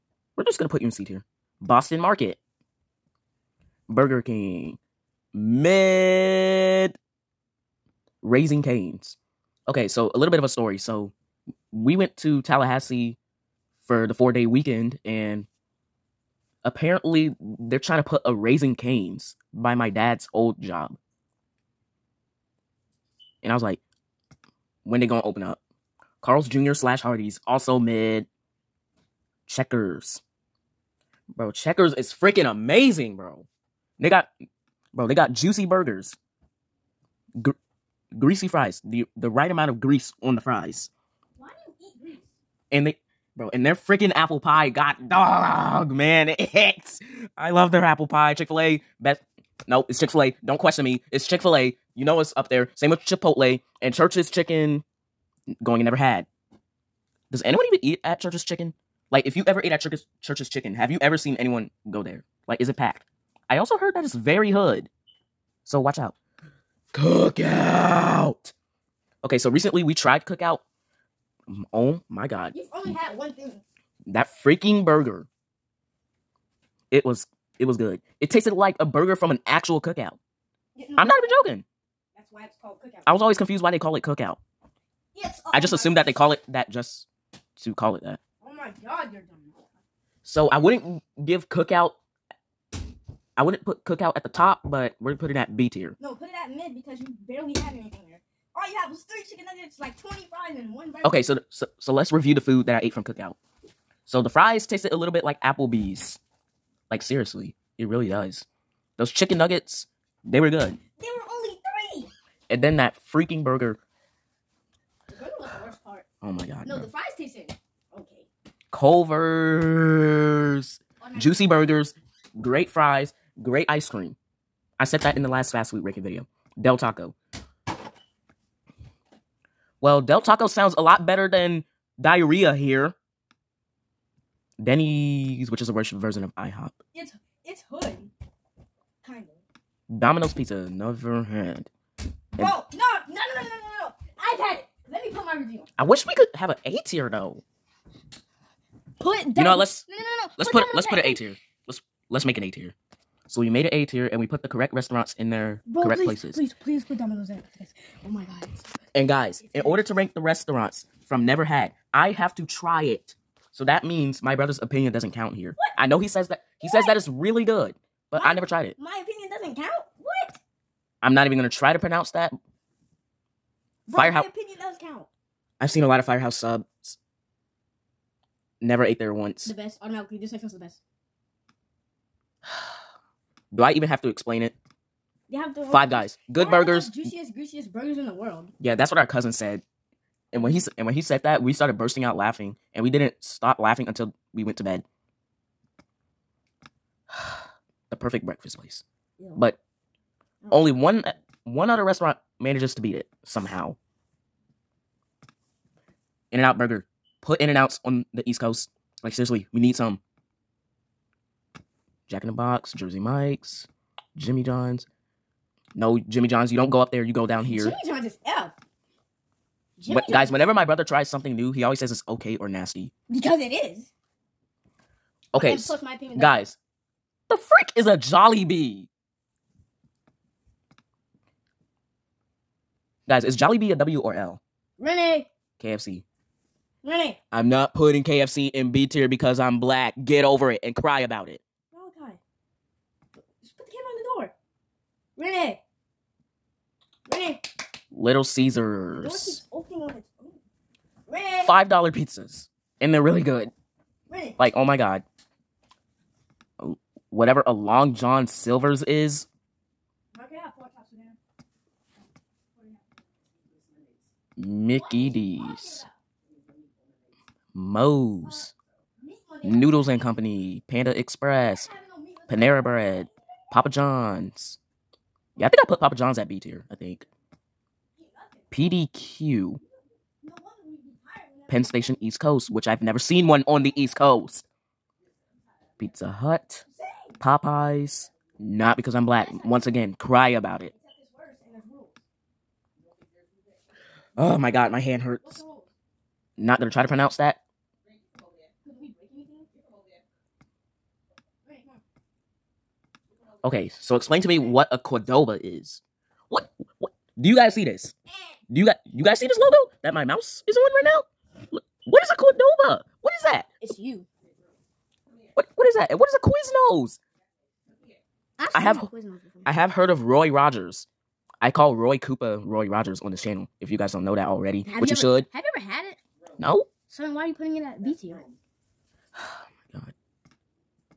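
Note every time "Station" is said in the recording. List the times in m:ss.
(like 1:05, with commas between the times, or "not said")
4:41.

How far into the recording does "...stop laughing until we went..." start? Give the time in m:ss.
3:13.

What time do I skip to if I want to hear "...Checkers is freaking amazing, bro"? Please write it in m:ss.
0:31.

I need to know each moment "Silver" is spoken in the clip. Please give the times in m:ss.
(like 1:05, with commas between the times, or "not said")
4:18.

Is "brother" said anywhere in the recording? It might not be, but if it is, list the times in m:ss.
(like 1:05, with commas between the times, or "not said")
2:44, 3:40.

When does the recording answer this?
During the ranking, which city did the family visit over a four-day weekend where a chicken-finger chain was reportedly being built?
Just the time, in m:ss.
0:12.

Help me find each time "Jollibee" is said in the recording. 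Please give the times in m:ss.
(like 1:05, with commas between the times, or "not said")
3:47, 3:53.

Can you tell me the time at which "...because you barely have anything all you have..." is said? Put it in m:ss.
1:36.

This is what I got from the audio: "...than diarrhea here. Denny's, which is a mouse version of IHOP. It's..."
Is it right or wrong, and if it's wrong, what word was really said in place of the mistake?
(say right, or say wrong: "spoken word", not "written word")
wrong: "worse", not "mouse".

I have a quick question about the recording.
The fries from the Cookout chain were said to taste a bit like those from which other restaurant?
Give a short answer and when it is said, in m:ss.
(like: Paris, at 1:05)
Applebee's, at 1:45.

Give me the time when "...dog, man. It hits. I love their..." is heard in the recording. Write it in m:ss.
0:45.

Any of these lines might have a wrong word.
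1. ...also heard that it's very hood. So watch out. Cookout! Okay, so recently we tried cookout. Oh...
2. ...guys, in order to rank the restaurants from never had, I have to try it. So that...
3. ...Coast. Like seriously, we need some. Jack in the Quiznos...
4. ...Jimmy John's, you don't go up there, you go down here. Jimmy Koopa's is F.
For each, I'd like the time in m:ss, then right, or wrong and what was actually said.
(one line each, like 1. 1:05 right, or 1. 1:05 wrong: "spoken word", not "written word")
1. 1:03 right
2. 2:39 right
3. 3:28 wrong: "Box", not "Quiznos"
4. 3:36 wrong: "John", not "Koopa".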